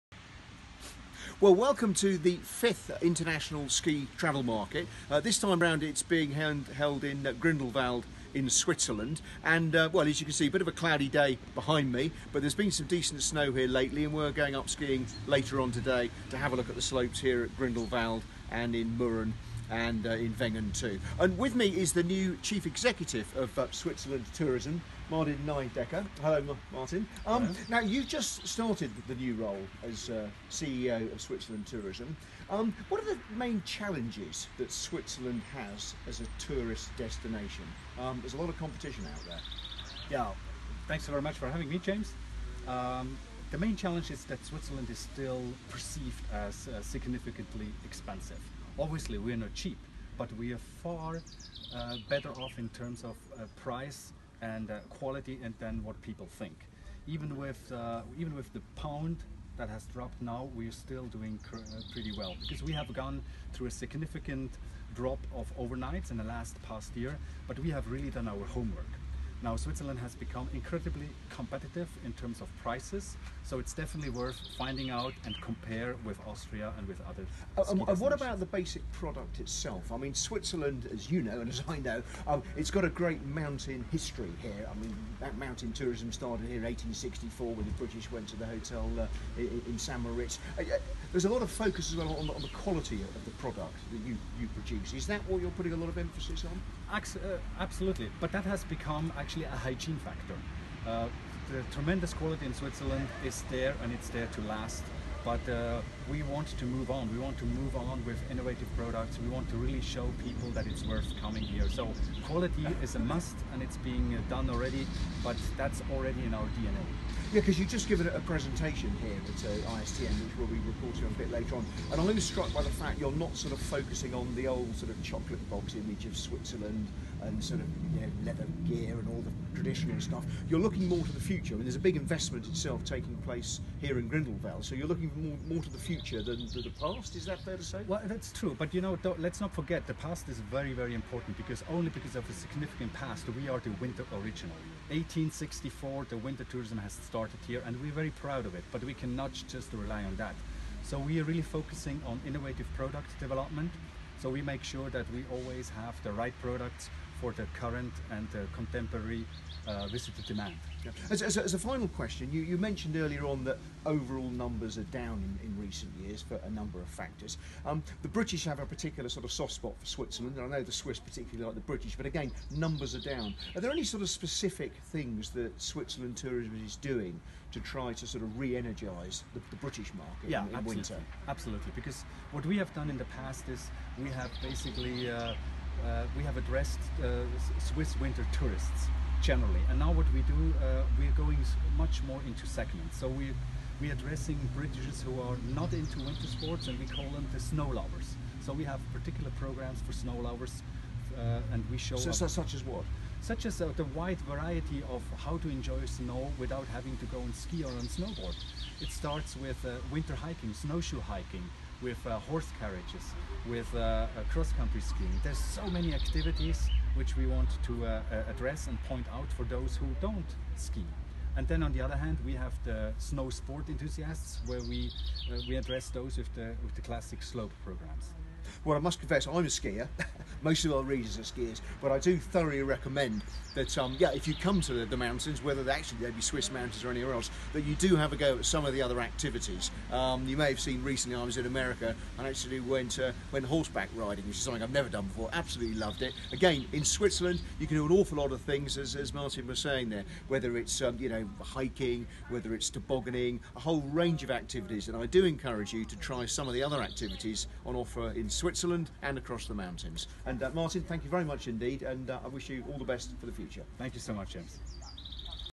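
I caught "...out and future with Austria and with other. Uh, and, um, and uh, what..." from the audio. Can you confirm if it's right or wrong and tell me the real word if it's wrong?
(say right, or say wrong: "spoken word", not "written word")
wrong: "compare", not "future".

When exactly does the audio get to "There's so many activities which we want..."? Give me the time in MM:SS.
03:35.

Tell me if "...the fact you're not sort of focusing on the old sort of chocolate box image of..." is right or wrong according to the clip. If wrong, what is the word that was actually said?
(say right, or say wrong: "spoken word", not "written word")
right.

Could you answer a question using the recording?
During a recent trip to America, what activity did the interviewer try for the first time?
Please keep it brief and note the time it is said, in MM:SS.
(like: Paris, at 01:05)
horseback riding, at 04:03.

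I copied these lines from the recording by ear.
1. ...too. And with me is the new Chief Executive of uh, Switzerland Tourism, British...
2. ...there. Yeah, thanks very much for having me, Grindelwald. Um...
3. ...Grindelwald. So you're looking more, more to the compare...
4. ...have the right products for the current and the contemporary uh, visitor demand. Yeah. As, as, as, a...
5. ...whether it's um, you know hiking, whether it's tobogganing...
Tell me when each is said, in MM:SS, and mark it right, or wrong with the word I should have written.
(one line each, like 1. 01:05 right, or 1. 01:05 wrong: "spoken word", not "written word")
1. 00:20 wrong: "Martin", not "British"
2. 00:39 wrong: "James", not "Grindelwald"
3. 02:14 wrong: "future", not "compare"
4. 02:35 right
5. 04:10 right.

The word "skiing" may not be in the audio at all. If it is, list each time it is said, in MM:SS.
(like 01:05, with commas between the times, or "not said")
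00:14, 03:34.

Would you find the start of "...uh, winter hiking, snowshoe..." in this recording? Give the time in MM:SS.
03:29.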